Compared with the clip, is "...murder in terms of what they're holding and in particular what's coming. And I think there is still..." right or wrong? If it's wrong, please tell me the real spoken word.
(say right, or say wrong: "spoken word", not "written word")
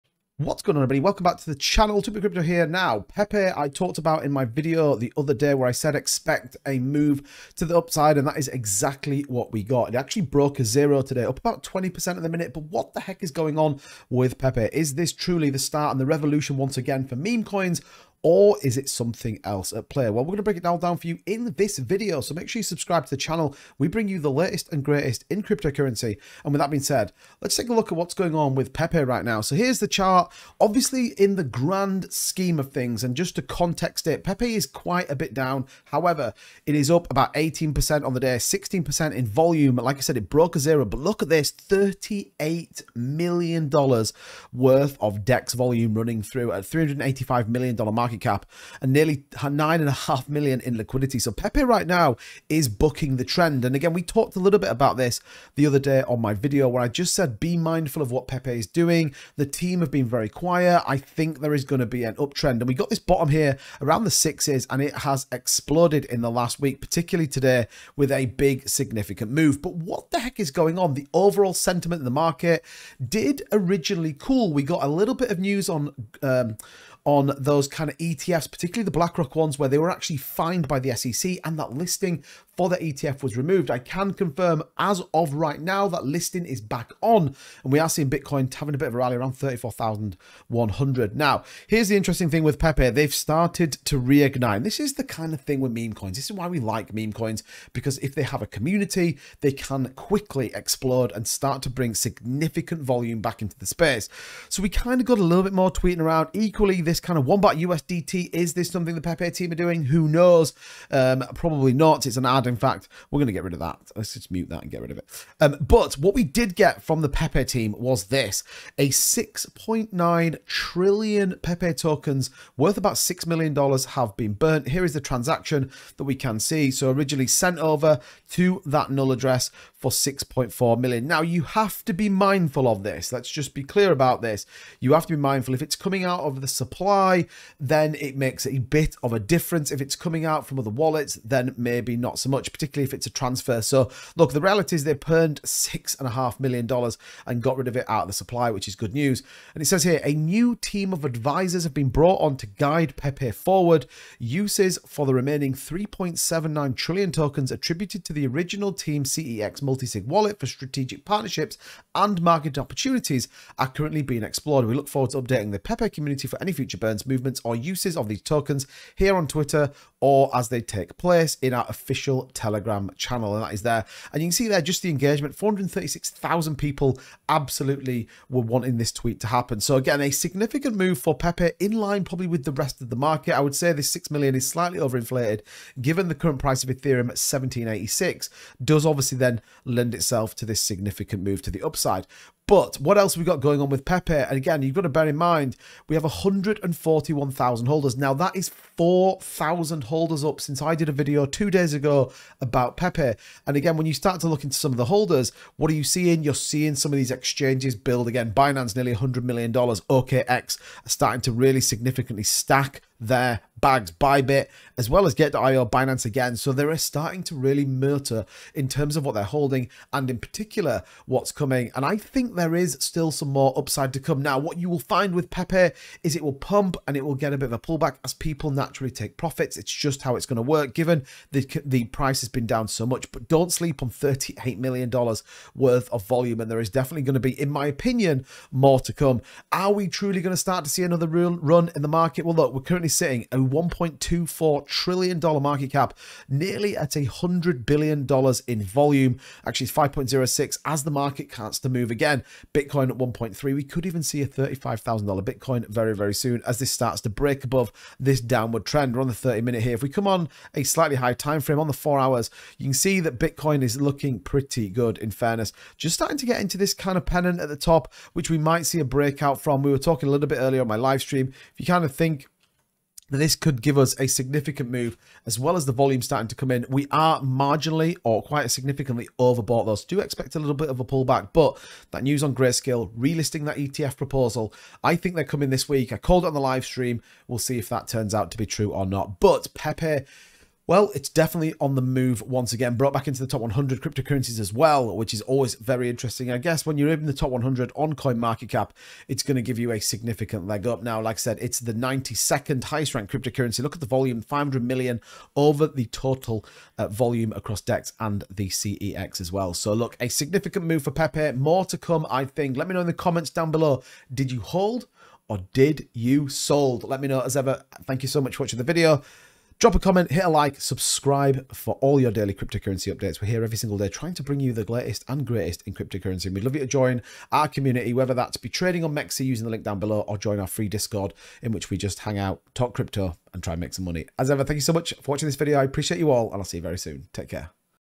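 right.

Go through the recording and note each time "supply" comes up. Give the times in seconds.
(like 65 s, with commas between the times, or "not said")
136 s, 148 s.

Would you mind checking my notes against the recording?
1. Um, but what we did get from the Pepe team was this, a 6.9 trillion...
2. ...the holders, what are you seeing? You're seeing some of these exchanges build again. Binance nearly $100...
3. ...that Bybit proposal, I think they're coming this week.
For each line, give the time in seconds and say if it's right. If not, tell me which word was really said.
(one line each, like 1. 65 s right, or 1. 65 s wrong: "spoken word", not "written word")
1. 115 s right
2. 204 s right
3. 283 s wrong: "ETF", not "Bybit".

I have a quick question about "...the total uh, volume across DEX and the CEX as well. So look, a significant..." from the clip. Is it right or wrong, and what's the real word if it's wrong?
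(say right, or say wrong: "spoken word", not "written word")
right.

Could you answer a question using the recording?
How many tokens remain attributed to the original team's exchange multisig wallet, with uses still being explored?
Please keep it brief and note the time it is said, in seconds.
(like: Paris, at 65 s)
3.79 trillion, at 155 s.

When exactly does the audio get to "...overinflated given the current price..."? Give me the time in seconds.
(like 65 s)
184 s.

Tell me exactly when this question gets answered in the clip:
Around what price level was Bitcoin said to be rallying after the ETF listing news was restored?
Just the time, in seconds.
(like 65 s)
89 s.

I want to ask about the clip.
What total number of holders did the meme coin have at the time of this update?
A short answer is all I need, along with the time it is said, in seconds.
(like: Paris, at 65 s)
141,000, at 196 s.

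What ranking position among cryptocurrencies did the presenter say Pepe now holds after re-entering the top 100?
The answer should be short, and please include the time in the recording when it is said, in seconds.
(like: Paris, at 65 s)
92nd, at 301 s.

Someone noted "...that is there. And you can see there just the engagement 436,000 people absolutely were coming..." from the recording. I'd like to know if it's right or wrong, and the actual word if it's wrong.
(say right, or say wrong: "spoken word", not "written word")
wrong: "wanting", not "coming".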